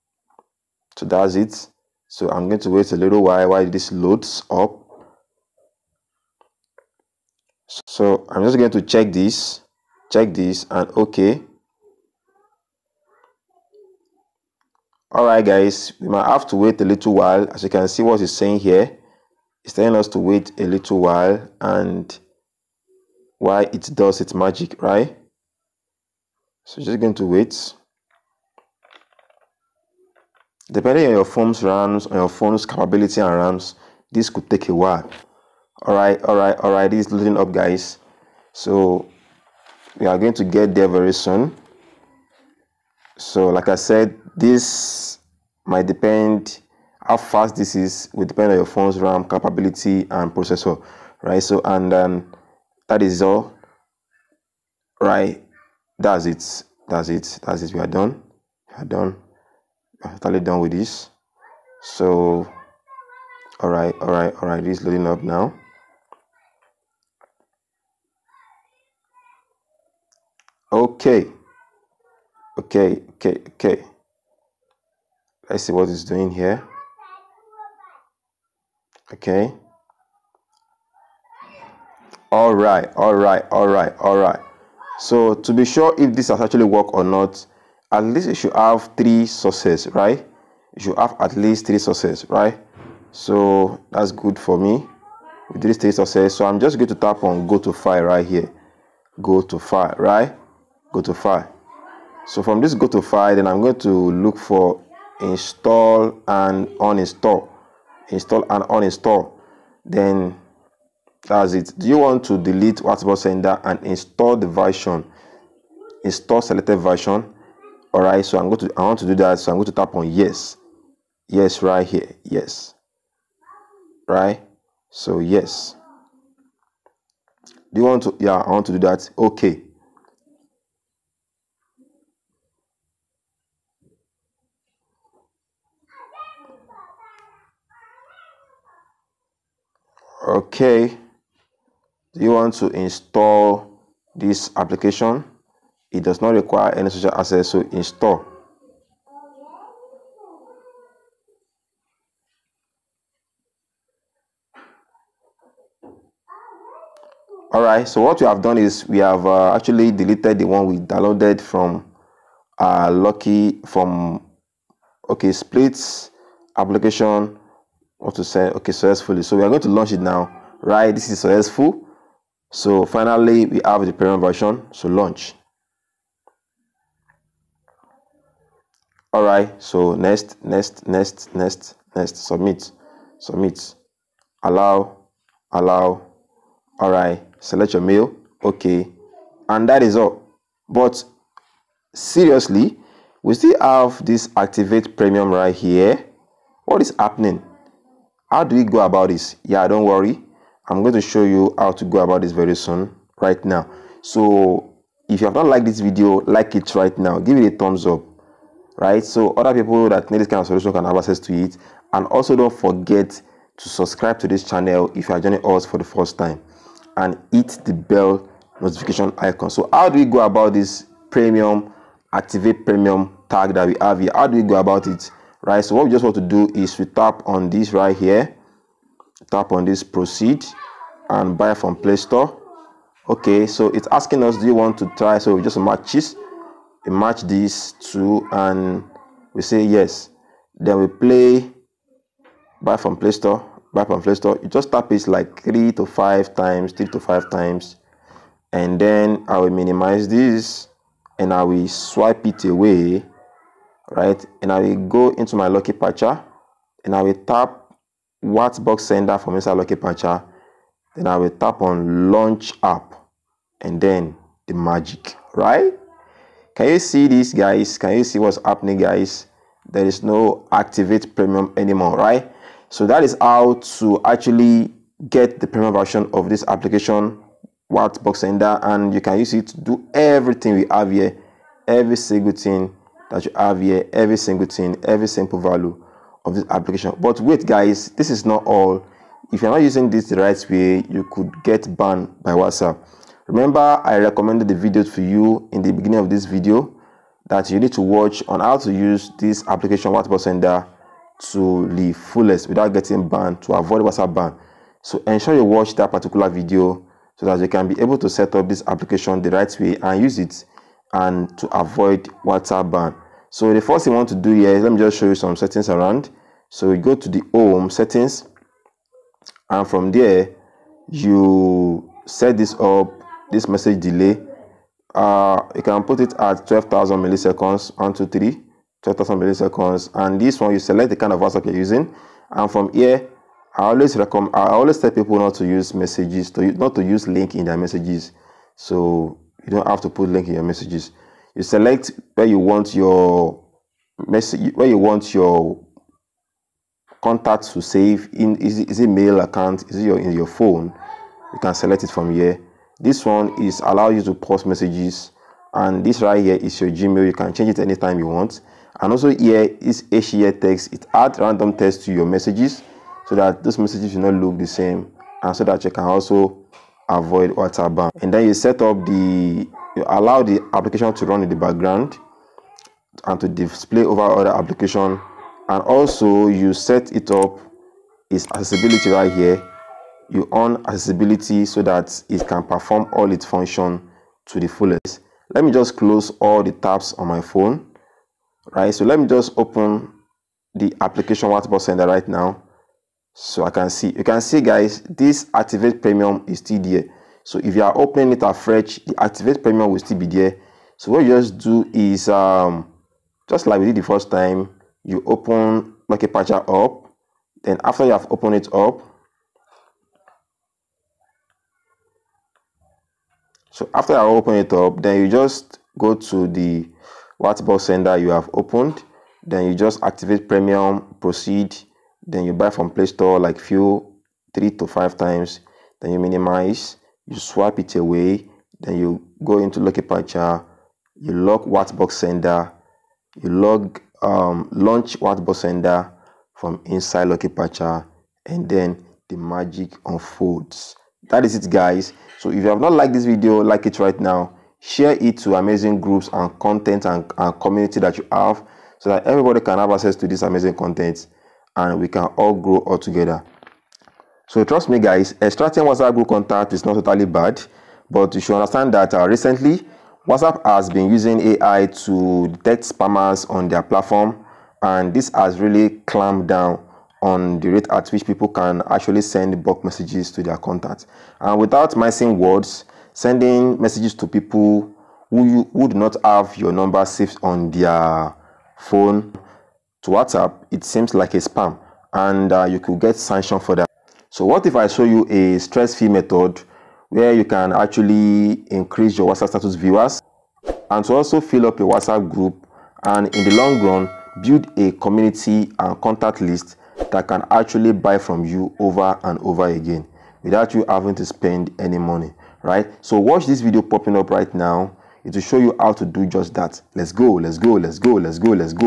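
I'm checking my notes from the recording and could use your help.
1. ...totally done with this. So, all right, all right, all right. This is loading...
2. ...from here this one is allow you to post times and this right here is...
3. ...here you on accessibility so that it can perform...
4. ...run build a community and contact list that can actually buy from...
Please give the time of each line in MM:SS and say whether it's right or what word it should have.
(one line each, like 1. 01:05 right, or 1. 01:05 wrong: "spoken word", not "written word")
1. 01:00 right
2. 05:51 wrong: "messages", not "times"
3. 06:19 right
4. 08:13 right.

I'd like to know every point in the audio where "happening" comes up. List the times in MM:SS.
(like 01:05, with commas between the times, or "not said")
03:16, 04:28.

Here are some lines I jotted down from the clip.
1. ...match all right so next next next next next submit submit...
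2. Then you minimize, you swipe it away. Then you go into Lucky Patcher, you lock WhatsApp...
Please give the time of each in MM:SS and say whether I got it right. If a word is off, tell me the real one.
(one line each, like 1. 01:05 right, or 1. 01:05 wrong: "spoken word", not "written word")
1. 02:54 wrong: "launch", not "match"
2. 07:05 right.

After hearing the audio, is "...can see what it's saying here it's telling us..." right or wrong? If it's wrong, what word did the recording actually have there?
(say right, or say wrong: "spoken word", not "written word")
right.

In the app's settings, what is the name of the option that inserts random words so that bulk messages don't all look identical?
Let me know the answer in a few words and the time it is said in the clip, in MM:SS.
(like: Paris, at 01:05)
HEA text, at 05:59.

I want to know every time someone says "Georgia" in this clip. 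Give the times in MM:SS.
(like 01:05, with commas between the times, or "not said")
not said.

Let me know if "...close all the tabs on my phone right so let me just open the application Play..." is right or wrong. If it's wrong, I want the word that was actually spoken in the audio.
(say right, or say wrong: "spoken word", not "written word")
wrong: "WhatsApp", not "Play".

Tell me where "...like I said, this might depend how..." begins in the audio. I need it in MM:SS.
00:43.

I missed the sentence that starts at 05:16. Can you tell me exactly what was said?
So you go to the home settings and from there you set this up, this message delay.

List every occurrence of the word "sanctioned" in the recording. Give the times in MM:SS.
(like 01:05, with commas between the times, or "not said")
08:02.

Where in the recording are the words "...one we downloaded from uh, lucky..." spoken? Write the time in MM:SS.
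02:40.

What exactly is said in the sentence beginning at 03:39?
So how do we go about this premium, activate premium tag that we have here?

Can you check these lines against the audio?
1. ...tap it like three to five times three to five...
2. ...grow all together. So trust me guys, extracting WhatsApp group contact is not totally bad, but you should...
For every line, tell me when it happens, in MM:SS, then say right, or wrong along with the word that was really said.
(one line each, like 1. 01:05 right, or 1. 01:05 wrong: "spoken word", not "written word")
1. 04:04 right
2. 07:32 right.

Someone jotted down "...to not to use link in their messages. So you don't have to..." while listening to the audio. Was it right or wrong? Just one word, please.
right.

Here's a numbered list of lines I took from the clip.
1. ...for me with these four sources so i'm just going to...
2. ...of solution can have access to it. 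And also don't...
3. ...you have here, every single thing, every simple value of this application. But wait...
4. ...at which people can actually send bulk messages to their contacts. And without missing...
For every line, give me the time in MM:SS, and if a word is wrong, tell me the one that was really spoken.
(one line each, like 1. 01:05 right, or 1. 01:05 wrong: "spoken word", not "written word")
1. 01:34 wrong: "three", not "four"
2. 03:30 right
3. 04:43 right
4. 07:47 right.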